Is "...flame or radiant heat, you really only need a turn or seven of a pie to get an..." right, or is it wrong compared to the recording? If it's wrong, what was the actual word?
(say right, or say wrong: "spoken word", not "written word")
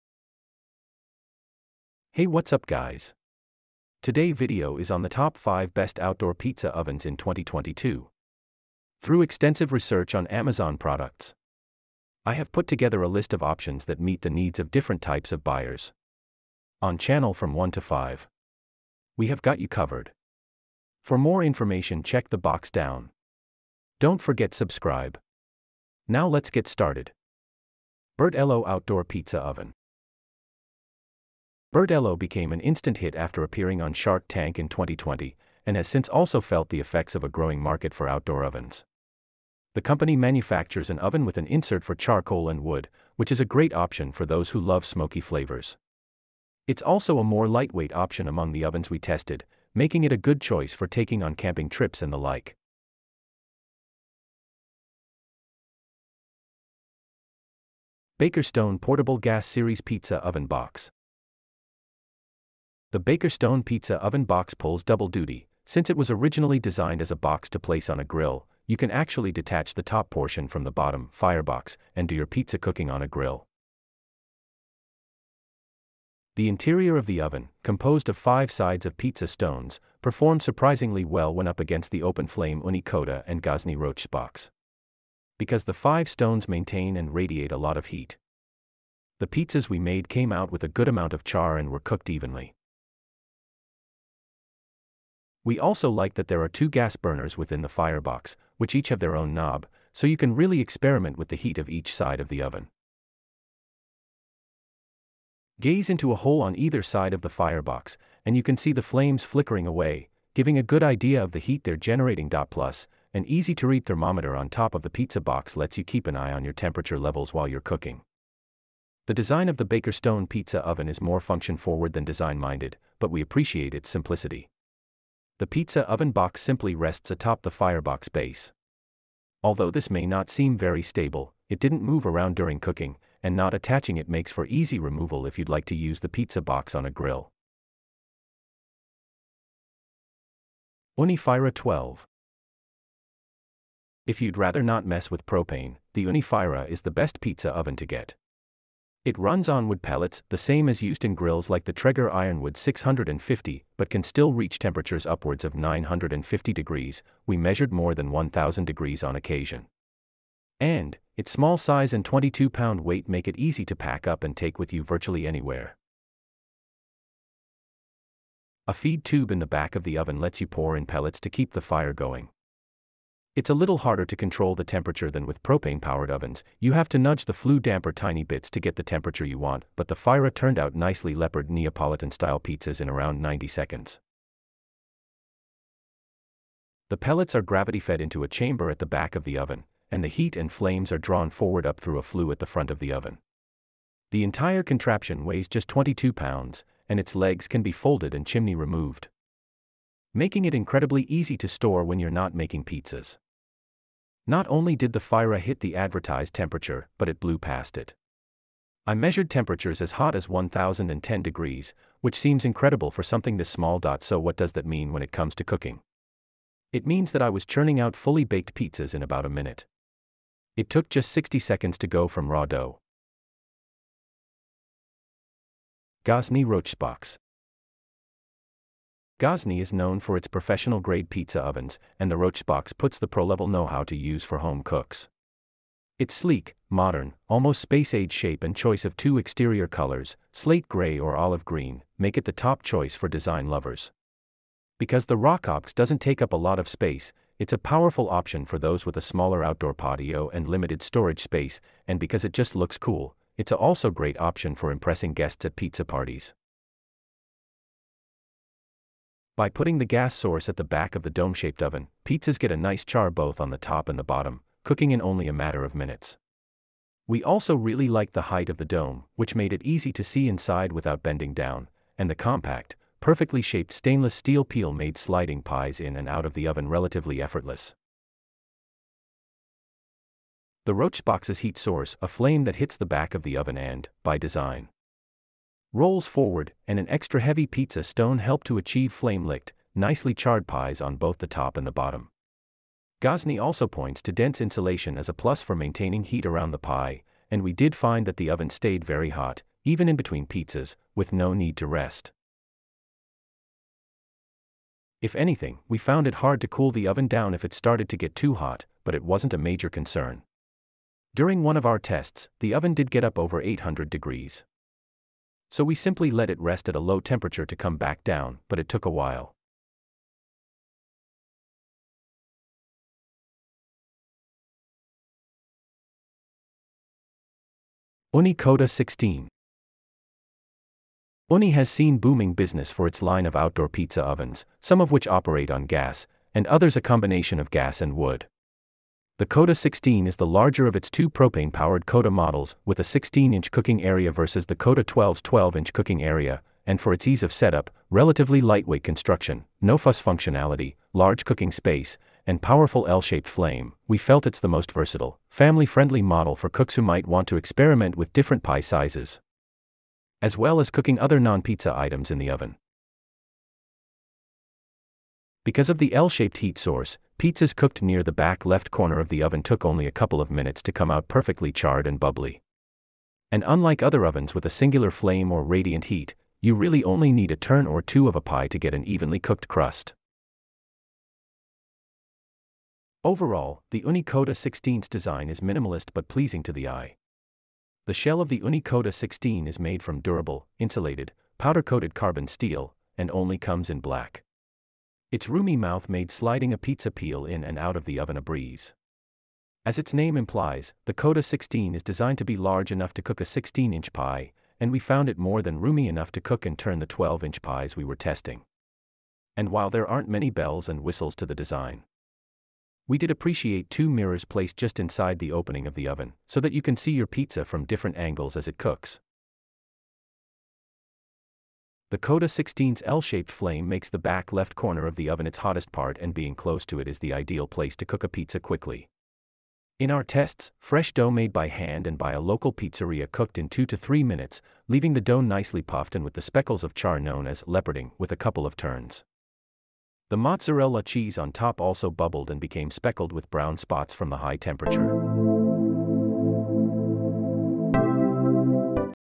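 wrong: "two", not "seven".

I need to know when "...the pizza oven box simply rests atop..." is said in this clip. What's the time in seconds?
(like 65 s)
125 s.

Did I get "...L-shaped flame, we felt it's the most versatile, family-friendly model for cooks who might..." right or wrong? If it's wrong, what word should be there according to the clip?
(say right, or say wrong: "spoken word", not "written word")
right.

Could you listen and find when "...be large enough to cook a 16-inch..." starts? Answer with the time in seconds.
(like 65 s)
402 s.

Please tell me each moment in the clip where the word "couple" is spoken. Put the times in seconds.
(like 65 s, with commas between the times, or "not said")
369 s, 438 s.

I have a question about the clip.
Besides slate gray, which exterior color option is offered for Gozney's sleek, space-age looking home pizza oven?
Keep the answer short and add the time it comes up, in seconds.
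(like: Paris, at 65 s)
olive green, at 241 s.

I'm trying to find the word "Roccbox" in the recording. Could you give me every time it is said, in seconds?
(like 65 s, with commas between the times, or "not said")
83 s, 226 s, 232 s, 245 s, 280 s.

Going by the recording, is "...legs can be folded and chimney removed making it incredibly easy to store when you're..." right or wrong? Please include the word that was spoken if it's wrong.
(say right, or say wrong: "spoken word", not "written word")
right.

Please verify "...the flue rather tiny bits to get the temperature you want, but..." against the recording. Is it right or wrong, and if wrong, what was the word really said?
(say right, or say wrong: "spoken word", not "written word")
wrong: "damper", not "rather".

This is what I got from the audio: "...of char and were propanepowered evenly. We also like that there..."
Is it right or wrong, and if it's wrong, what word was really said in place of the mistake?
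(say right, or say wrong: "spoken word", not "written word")
wrong: "cooked", not "propanepowered".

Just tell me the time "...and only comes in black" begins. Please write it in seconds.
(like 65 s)
392 s.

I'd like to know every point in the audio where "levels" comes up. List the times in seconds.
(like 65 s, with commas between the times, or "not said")
116 s, 233 s.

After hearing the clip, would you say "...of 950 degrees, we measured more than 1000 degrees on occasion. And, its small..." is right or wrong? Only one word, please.
right.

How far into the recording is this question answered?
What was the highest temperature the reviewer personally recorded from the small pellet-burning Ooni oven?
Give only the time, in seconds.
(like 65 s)
210 s.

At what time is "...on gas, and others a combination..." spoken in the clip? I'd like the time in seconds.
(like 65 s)
335 s.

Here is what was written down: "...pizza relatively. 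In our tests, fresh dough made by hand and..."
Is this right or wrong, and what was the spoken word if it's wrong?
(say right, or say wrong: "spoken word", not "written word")
wrong: "quickly", not "relatively".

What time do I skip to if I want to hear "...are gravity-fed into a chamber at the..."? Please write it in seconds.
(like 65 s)
187 s.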